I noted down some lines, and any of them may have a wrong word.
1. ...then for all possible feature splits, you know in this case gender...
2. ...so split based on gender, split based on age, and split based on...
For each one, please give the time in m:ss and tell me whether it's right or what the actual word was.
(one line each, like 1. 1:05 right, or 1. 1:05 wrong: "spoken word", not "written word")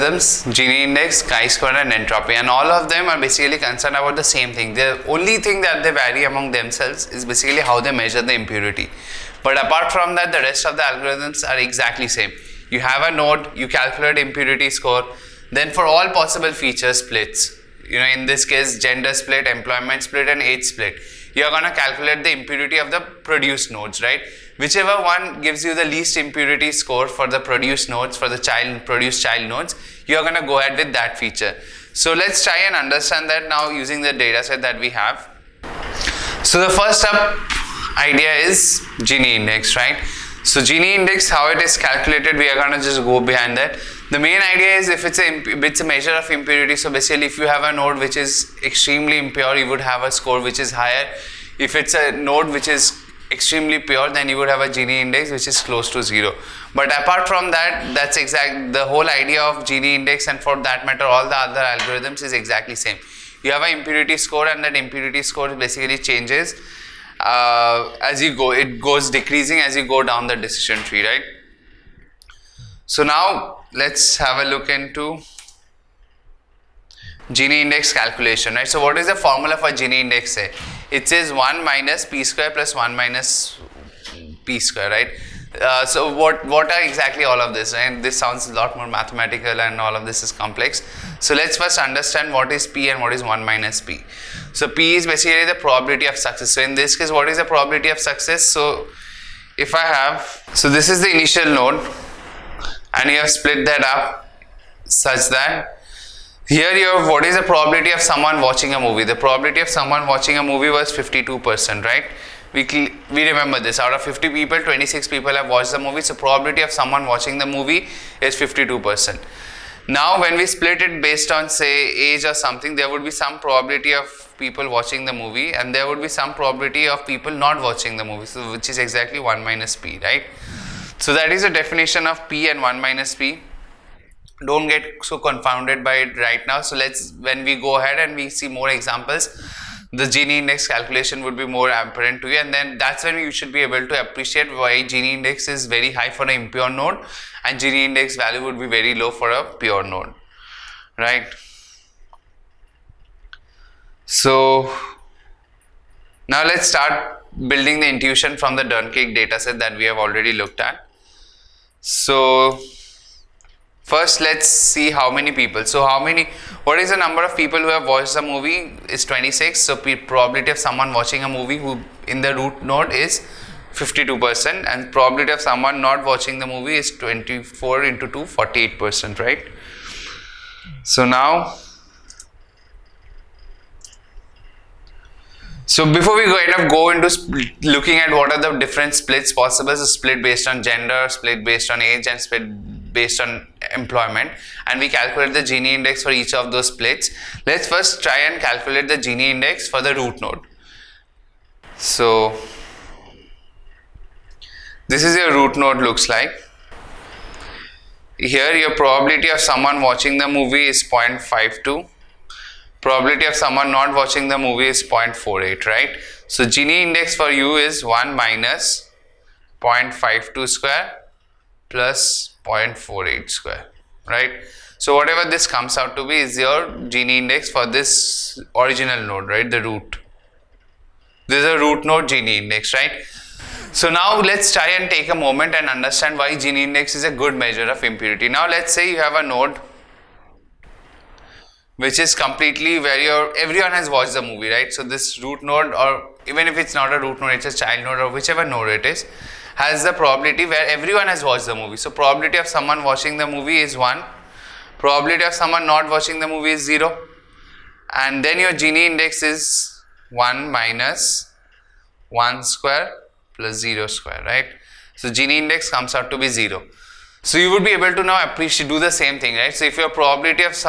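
1. 0:15 right
2. 3:09 right.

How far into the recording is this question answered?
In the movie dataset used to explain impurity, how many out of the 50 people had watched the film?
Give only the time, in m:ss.
1:54.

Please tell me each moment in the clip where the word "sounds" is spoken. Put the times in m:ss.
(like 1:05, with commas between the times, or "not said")
1:28.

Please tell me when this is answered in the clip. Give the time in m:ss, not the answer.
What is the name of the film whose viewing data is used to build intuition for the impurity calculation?
2:38.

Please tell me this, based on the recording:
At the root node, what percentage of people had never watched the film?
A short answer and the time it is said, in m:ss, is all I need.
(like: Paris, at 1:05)
48%, at 2:58.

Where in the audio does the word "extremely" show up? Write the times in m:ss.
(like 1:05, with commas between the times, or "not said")
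0:48, 0:53.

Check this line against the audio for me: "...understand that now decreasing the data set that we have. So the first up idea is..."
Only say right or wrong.
wrong.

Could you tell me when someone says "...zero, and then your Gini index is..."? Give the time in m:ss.
4:16.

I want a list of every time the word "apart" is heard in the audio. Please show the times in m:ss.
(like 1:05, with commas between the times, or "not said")
0:09, 0:56.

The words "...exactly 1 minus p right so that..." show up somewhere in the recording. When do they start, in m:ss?
2:08.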